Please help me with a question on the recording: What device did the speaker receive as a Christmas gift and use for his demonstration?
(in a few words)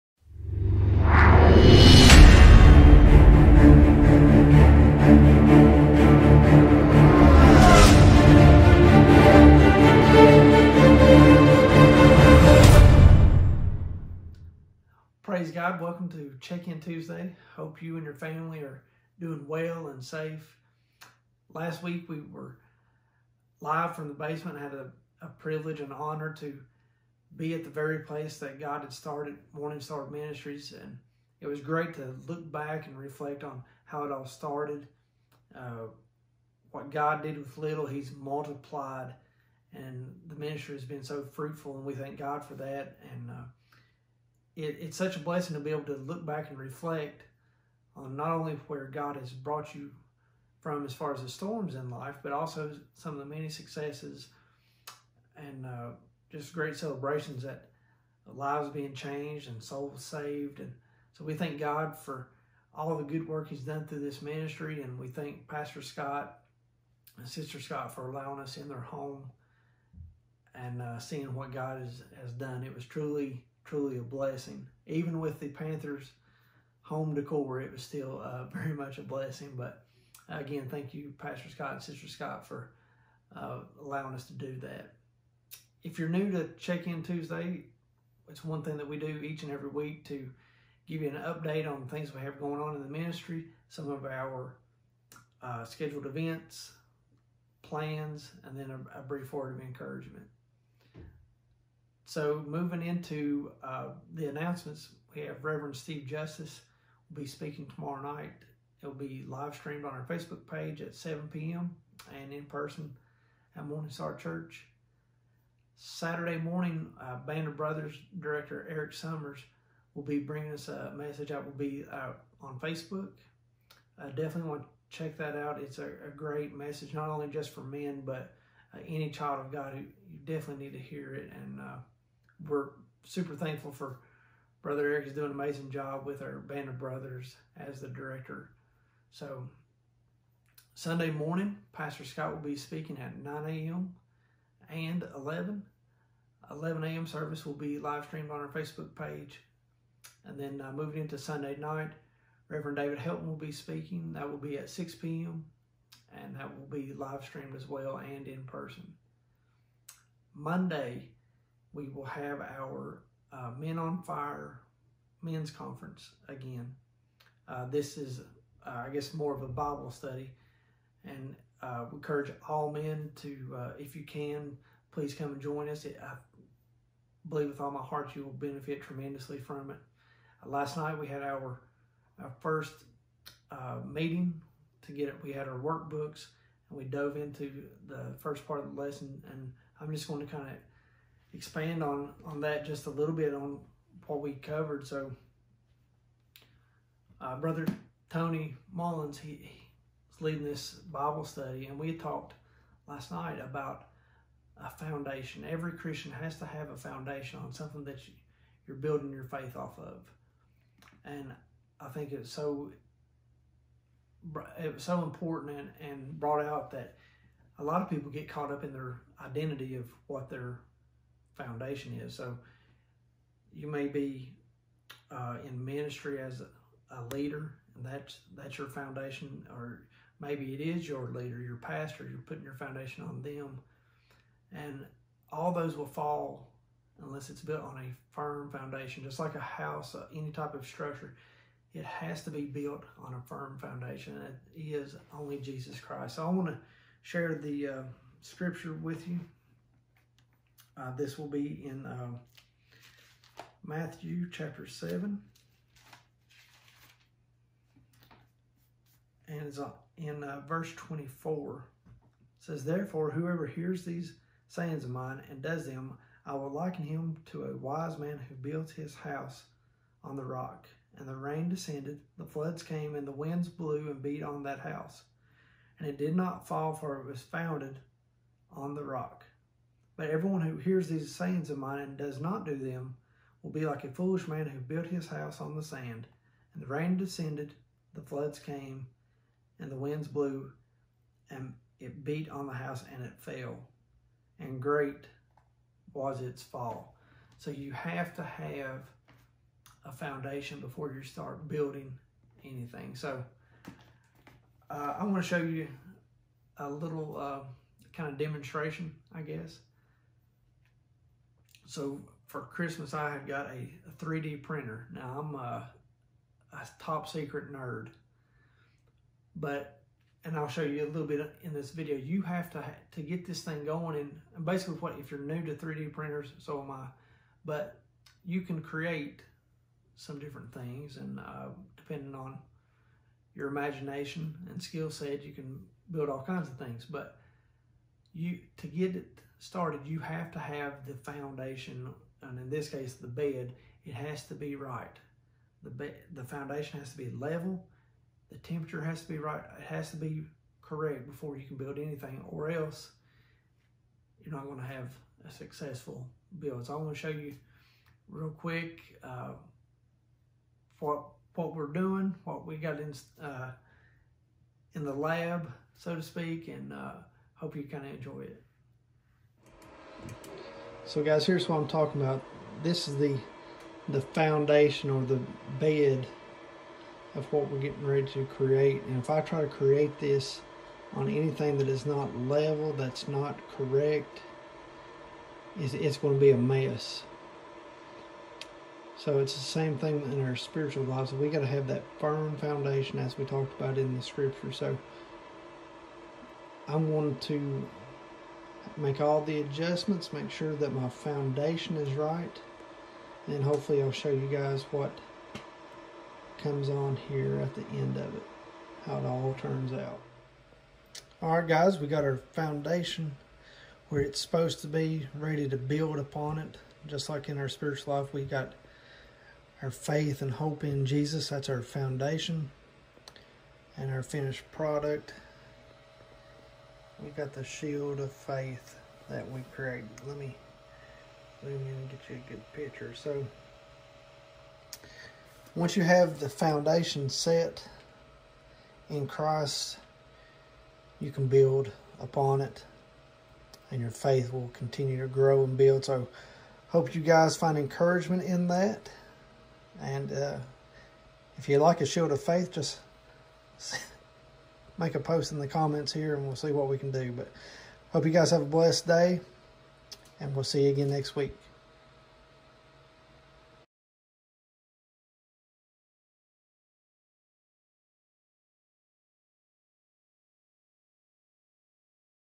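3D printer.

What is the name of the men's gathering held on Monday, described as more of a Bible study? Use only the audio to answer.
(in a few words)
Men on Fire.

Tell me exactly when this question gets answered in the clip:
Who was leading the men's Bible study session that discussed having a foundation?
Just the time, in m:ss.
3:18.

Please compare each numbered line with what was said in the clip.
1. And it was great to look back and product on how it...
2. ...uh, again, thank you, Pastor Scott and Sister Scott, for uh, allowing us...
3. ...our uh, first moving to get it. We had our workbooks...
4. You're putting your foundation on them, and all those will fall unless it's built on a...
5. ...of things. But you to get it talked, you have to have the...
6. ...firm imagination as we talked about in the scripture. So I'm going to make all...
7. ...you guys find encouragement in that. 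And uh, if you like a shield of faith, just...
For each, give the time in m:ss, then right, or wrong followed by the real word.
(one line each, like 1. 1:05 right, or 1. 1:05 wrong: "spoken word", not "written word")
1. 0:30 wrong: "reflect", not "product"
2. 1:20 right
3. 3:02 wrong: "meeting", not "moving"
4. 3:52 right
5. 5:36 wrong: "started", not "talked"
6. 6:32 wrong: "foundation", not "imagination"
7. 7:26 right.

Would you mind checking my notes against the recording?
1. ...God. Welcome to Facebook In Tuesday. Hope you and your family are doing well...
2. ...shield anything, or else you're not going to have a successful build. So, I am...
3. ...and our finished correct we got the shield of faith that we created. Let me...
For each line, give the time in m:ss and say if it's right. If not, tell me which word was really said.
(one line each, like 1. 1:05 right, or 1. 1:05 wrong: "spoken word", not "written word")
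1. 0:15 wrong: "Check", not "Facebook"
2. 5:51 wrong: "build", not "shield"
3. 7:03 wrong: "product", not "correct".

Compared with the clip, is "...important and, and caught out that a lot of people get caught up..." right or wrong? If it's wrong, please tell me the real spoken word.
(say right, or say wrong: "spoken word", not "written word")
wrong: "brought", not "caught".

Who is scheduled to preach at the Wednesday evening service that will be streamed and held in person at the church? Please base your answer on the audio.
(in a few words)
Steve Justice.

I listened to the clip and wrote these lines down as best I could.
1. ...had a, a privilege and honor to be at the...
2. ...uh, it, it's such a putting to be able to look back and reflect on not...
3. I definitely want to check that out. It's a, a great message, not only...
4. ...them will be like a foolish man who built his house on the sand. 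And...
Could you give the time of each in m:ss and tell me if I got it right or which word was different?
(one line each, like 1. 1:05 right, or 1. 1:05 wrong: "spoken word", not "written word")
1. 0:24 right
2. 0:43 wrong: "blessing", not "putting"
3. 2:04 right
4. 4:42 right.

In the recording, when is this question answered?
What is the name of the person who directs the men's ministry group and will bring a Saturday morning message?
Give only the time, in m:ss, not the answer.
1:58.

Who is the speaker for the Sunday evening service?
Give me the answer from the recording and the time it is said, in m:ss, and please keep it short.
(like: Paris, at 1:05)
David Helton, at 2:32.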